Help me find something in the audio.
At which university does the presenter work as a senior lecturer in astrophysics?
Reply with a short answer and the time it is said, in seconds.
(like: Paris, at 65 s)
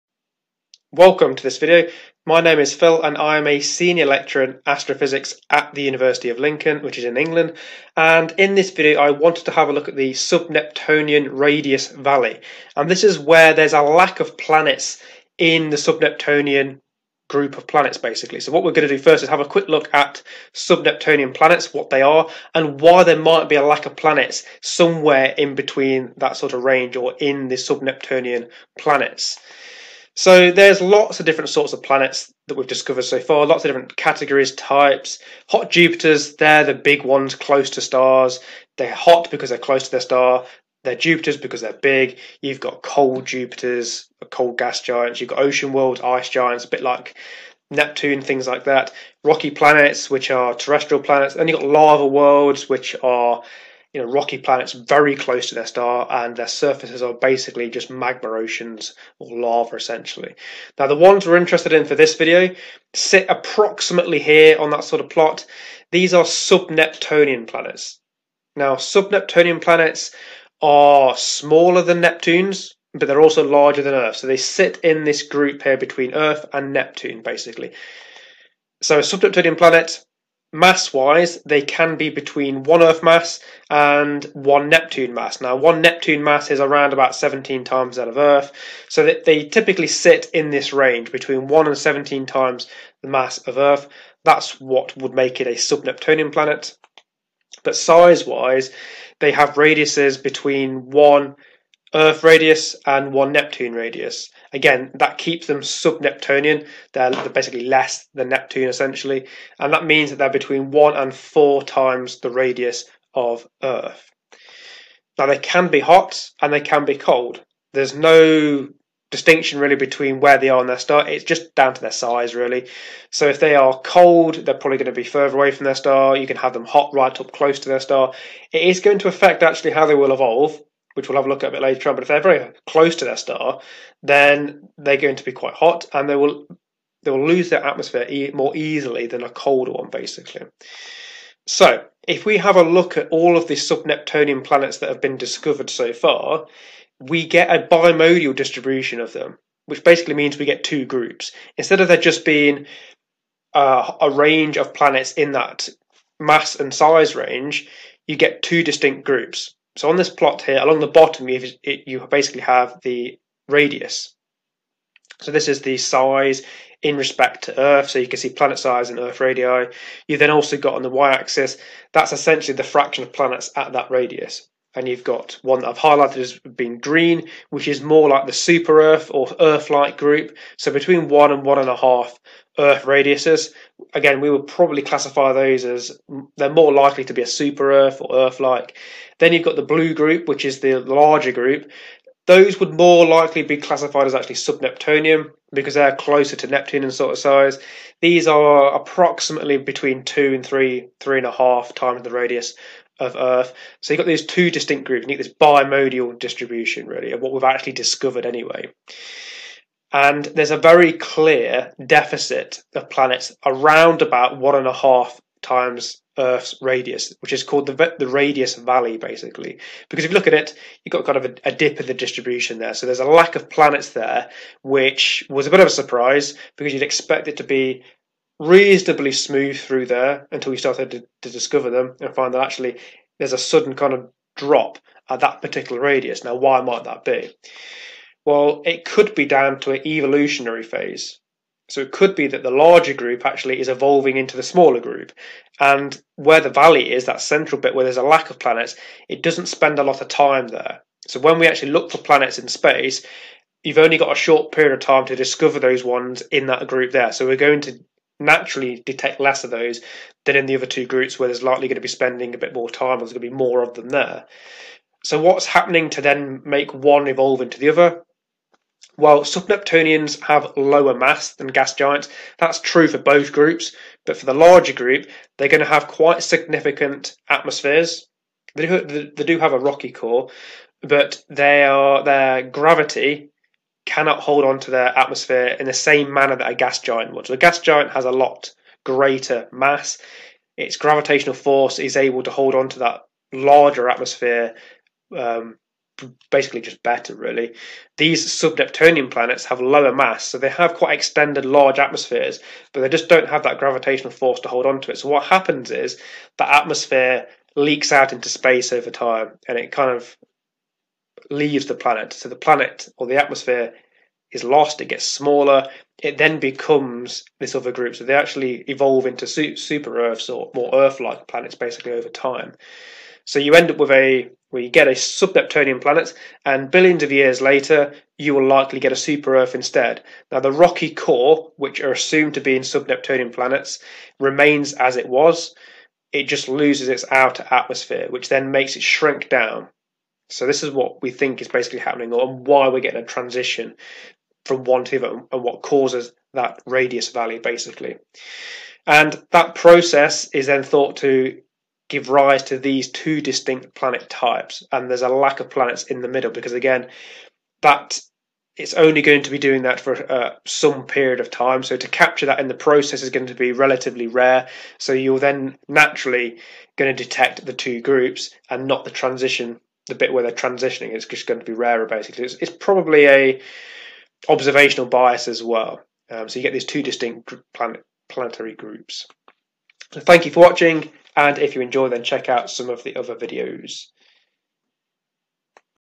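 University of Lincoln, at 5 s.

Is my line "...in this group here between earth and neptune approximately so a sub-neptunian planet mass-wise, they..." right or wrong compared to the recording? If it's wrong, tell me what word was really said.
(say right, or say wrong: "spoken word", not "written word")
wrong: "basically", not "approximately".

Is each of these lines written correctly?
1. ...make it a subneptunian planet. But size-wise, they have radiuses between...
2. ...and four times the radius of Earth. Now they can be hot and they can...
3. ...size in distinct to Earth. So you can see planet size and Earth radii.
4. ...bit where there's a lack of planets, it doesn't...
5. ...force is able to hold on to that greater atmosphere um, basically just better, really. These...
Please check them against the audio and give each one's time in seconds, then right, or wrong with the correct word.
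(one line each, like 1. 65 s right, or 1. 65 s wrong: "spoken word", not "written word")
1. 95 s right
2. 110 s right
3. 165 s wrong: "respect", not "distinct"
4. 247 s right
5. 291 s wrong: "larger", not "greater".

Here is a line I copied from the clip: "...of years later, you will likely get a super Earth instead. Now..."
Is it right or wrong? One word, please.
right.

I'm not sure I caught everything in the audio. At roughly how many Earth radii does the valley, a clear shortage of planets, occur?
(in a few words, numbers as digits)
1.5.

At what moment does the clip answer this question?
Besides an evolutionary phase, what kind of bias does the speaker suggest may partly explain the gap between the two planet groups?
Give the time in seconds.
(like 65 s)
374 s.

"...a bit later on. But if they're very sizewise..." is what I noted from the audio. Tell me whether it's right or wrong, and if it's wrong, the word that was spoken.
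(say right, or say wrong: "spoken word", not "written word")
wrong: "close", not "sizewise".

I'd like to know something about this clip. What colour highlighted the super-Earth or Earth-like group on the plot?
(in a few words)
Green.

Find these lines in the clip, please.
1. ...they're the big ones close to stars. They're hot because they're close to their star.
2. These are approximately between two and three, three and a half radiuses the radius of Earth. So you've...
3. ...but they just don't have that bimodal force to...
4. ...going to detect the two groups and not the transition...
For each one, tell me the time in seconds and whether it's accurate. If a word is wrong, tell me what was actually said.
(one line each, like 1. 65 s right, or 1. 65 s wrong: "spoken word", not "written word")
1. 36 s right
2. 198 s wrong: "times", not "radiuses"
3. 302 s wrong: "gravitational", not "bimodal"
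4. 366 s right.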